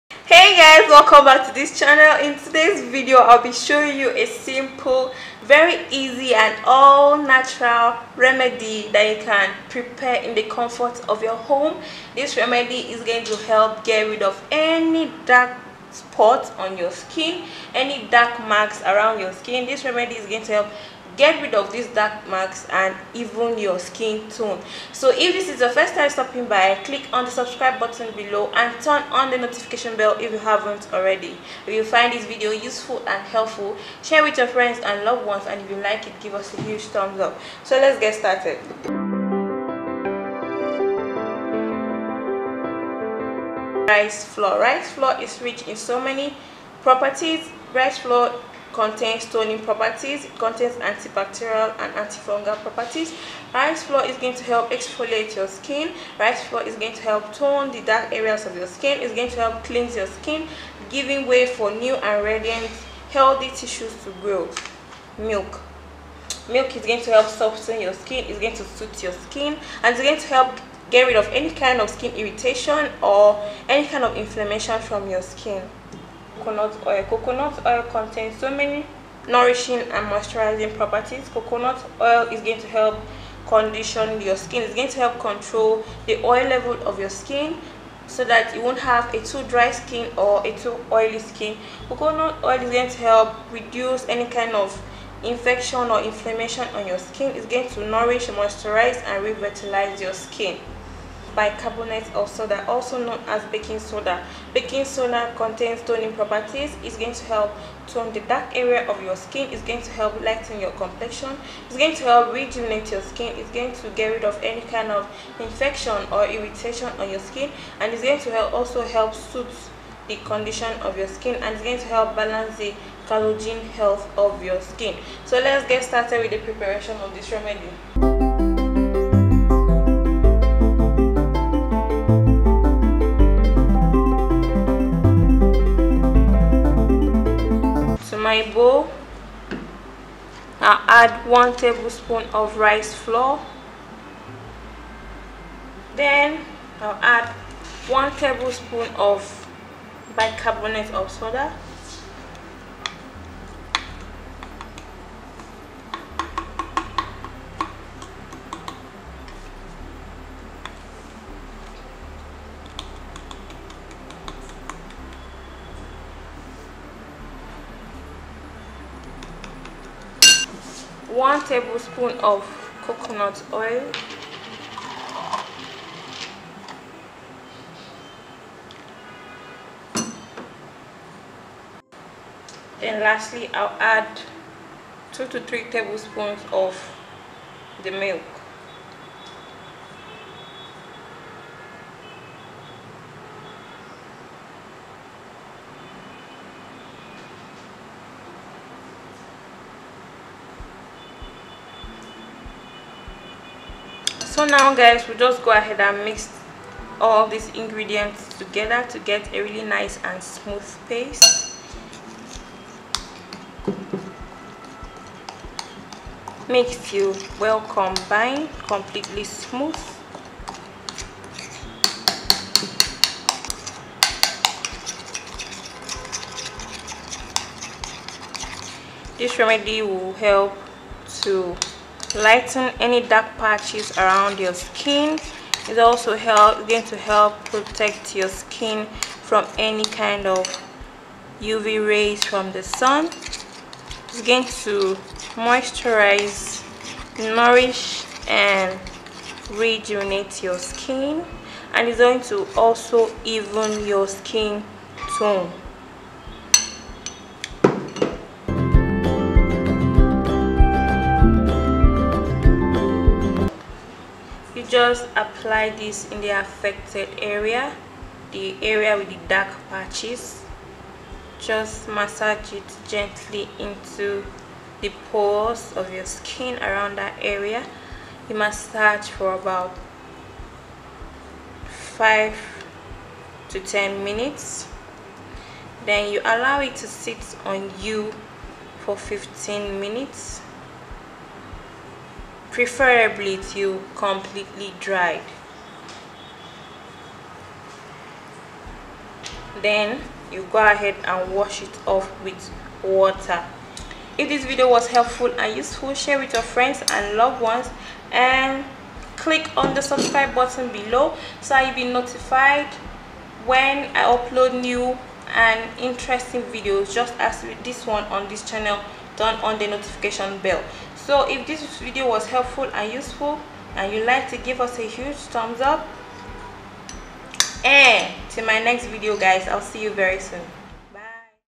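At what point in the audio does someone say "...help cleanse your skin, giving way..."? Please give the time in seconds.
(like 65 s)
59 s.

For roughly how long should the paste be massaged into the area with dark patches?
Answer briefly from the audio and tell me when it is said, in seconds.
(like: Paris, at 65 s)
5 to 10 minutes, at 281 s.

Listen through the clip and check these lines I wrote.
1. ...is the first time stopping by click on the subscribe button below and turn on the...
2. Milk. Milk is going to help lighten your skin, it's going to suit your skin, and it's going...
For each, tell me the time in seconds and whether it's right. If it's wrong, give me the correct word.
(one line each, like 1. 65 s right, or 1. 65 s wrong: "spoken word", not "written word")
1. 25 s right
2. 65 s wrong: "soften", not "lighten".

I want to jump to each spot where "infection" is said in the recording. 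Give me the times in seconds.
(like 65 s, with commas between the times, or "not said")
95 s, 115 s.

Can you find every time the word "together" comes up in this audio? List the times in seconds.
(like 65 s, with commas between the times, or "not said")
208 s.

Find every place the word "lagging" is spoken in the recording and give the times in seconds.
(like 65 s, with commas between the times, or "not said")
not said.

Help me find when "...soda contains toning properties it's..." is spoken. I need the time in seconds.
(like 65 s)
104 s.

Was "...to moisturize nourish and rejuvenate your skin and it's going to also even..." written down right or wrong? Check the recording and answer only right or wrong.
right.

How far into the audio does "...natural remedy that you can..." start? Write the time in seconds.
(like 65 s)
7 s.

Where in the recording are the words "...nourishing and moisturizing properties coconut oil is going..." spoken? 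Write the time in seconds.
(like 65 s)
79 s.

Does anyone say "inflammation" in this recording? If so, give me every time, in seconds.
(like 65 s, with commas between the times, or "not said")
74 s, 96 s.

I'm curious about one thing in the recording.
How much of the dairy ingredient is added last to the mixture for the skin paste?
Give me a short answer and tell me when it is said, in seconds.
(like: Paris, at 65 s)
2 to 3 tablespoons, at 185 s.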